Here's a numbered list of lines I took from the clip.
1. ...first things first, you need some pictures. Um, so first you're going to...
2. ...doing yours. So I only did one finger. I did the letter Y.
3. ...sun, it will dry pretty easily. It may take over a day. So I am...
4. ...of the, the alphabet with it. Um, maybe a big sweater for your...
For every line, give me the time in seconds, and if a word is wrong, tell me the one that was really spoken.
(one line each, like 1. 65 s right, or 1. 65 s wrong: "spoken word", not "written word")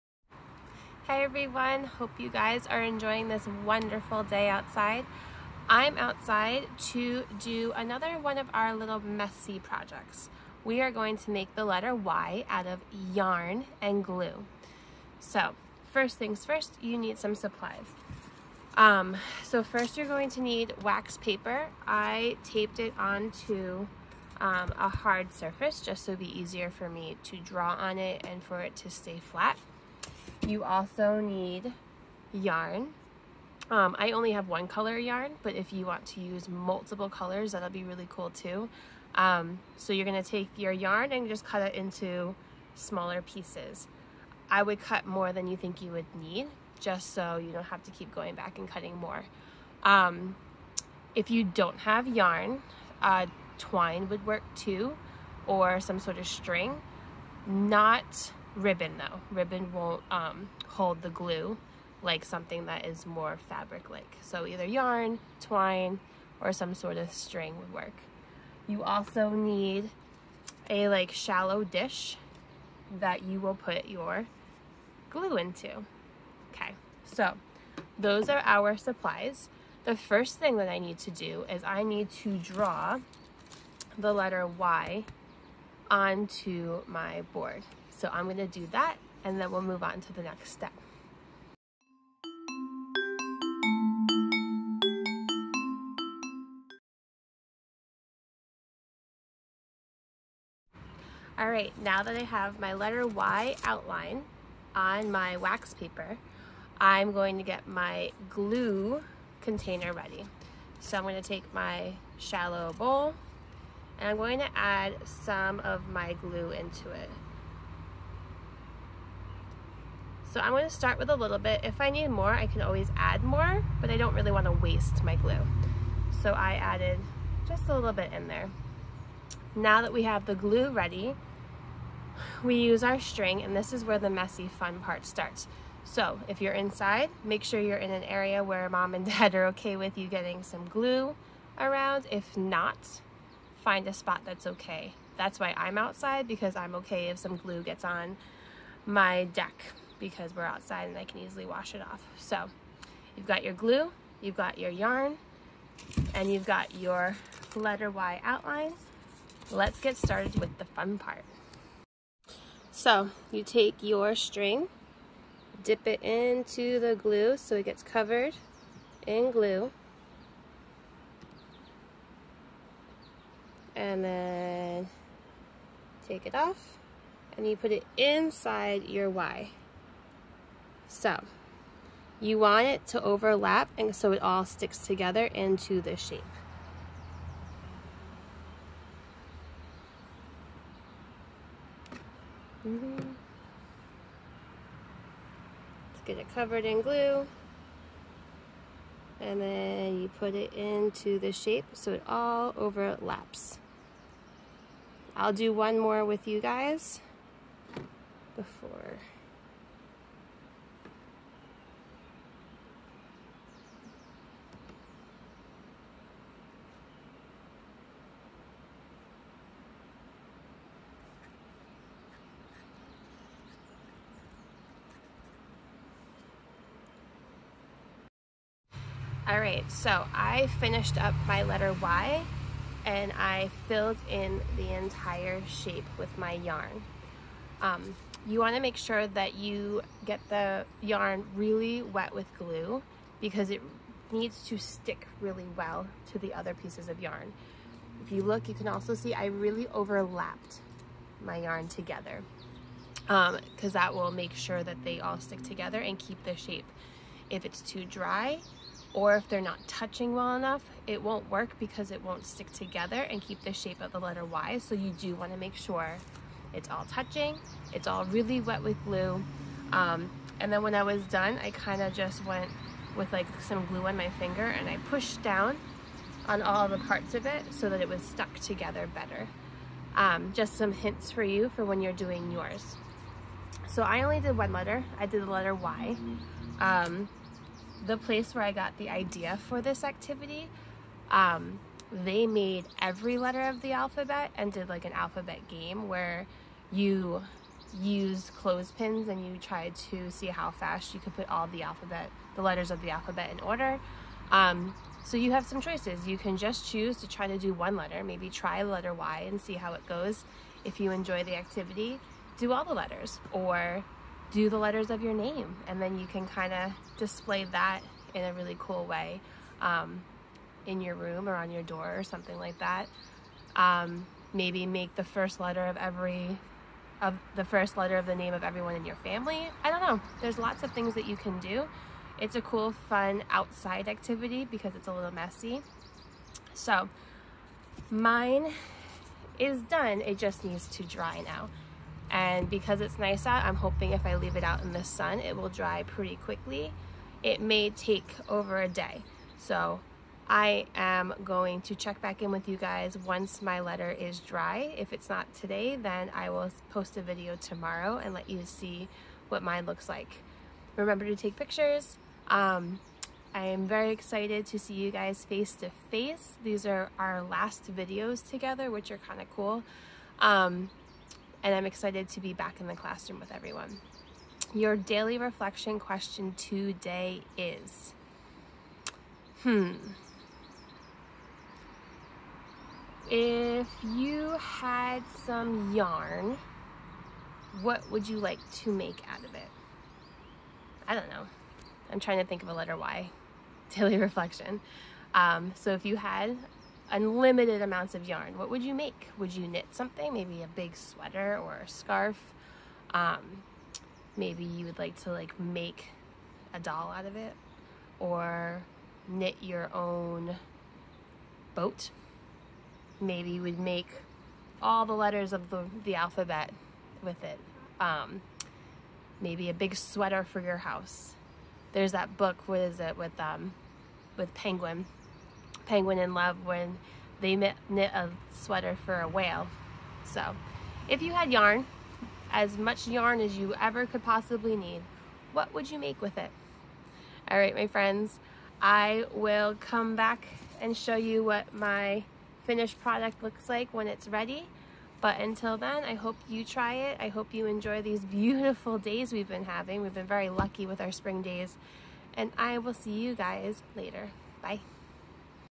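1. 15 s wrong: "supplies", not "pictures"
2. 281 s wrong: "letter", not "finger"
3. 344 s wrong: "quickly", not "easily"
4. 415 s right.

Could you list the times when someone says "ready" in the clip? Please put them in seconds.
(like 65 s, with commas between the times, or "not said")
109 s, 130 s, 444 s.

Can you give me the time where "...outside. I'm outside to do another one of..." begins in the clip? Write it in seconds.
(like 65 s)
4 s.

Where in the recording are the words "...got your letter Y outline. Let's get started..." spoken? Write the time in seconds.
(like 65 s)
156 s.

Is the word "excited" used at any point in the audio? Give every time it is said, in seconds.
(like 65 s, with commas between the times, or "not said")
363 s, 371 s.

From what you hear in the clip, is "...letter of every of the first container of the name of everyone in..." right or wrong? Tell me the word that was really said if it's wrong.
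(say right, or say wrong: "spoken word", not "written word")
wrong: "letter", not "container".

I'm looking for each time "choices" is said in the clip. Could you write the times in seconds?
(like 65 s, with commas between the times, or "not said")
305 s.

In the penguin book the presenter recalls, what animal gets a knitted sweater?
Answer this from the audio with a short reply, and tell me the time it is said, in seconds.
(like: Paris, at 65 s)
A whale, at 429 s.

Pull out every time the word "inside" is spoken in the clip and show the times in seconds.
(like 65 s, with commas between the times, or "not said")
136 s, 177 s.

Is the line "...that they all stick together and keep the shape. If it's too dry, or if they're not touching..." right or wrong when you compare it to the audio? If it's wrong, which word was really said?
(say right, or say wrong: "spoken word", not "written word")
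right.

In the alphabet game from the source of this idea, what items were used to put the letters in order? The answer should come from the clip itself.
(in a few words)
Clothespins.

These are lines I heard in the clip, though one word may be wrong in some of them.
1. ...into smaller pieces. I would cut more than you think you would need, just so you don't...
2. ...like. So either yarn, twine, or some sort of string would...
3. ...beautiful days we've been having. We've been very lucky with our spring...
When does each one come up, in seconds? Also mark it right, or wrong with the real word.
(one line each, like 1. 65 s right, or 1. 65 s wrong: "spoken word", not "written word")
1. 41 s right
2. 63 s right
3. 448 s right.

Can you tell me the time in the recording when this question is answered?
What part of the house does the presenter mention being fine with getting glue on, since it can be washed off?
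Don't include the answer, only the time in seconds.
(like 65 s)
149 s.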